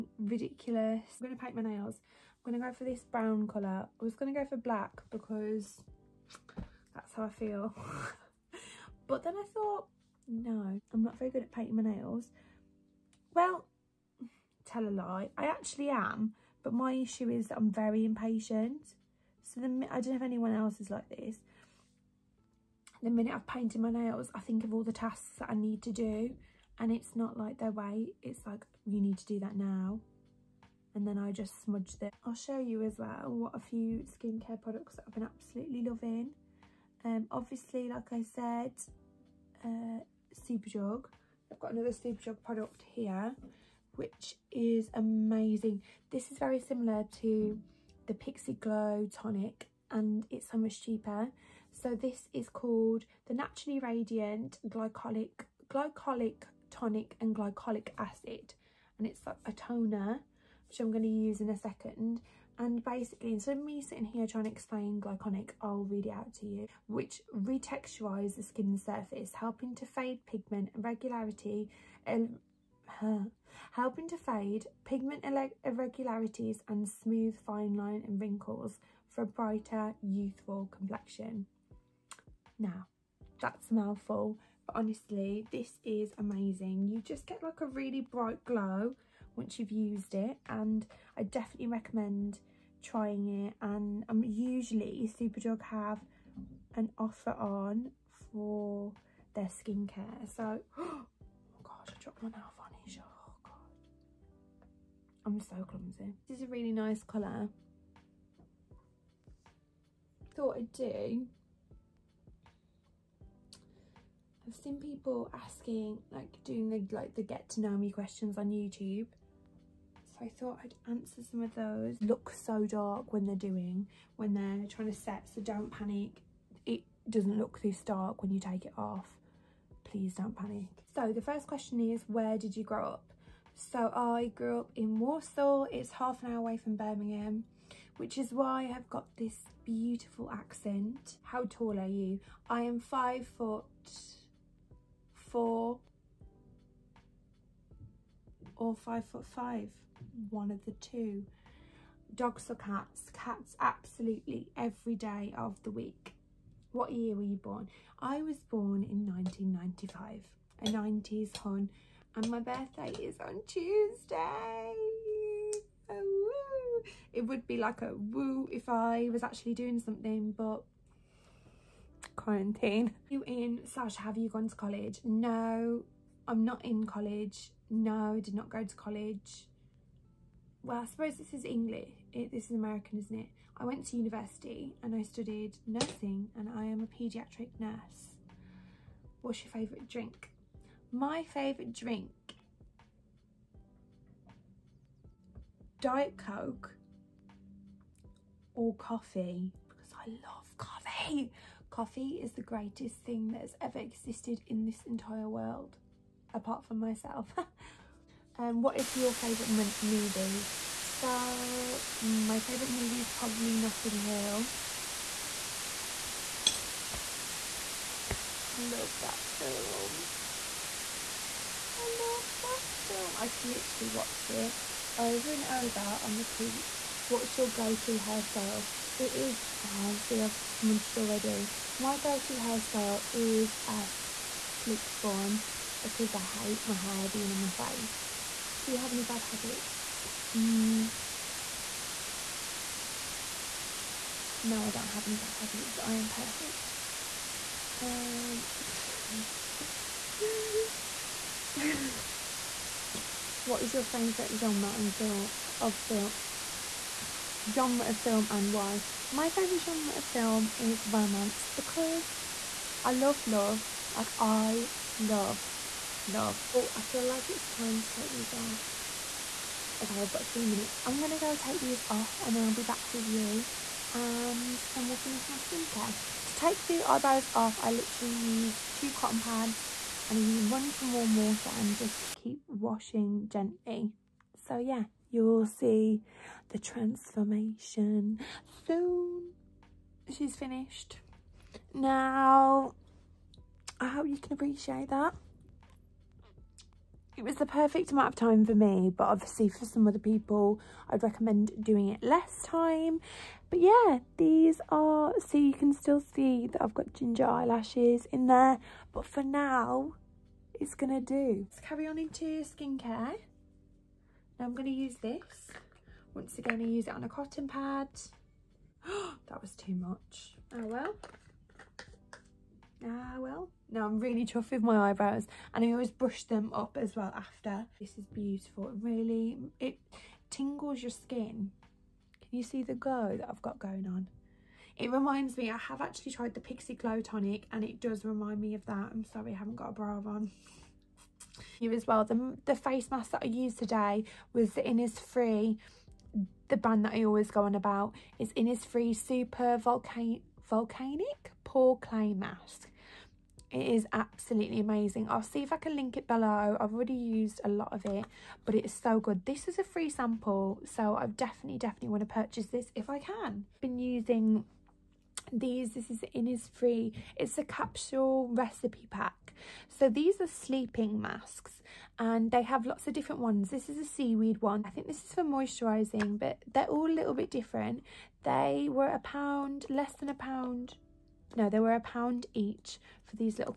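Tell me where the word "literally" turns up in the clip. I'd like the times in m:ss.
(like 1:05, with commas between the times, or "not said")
3:43, 4:37.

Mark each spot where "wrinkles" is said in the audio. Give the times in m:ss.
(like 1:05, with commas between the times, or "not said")
1:18.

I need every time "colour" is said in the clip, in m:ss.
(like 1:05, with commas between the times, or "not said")
0:03, 1:47.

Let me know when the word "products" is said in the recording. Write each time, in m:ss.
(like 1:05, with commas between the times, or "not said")
0:34, 0:42.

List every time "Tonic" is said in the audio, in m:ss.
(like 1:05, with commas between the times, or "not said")
0:49, 0:56, 5:36.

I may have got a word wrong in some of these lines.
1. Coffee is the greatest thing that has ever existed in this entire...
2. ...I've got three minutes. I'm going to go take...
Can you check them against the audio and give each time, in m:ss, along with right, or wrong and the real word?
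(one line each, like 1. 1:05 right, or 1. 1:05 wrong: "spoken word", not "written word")
1. 3:21 right
2. 4:30 right.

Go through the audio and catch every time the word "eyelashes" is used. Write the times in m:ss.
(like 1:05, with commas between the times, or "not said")
5:07.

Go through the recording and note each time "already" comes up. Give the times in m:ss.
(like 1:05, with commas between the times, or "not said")
3:50, 5:56.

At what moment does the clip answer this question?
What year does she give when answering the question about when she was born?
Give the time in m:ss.
2:39.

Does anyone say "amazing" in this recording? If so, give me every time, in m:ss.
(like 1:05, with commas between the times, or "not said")
0:44, 1:26, 5:54.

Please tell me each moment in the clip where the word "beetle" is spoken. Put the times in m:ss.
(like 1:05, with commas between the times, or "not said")
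not said.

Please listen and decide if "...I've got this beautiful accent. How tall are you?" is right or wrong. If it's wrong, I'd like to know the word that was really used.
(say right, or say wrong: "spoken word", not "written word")
right.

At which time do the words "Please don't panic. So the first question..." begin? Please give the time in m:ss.
2:09.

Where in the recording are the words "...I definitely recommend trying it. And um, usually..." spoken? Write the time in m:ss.
1:31.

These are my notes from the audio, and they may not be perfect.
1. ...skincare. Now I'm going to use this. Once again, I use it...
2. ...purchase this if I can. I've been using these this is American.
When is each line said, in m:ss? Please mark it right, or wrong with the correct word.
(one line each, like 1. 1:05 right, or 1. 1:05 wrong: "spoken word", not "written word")
1. 5:12 right
2. 6:02 wrong: "Innisfree", not "American".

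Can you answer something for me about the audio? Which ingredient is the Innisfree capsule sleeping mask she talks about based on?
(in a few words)
Seaweed.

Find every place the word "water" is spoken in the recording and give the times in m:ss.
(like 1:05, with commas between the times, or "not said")
4:41.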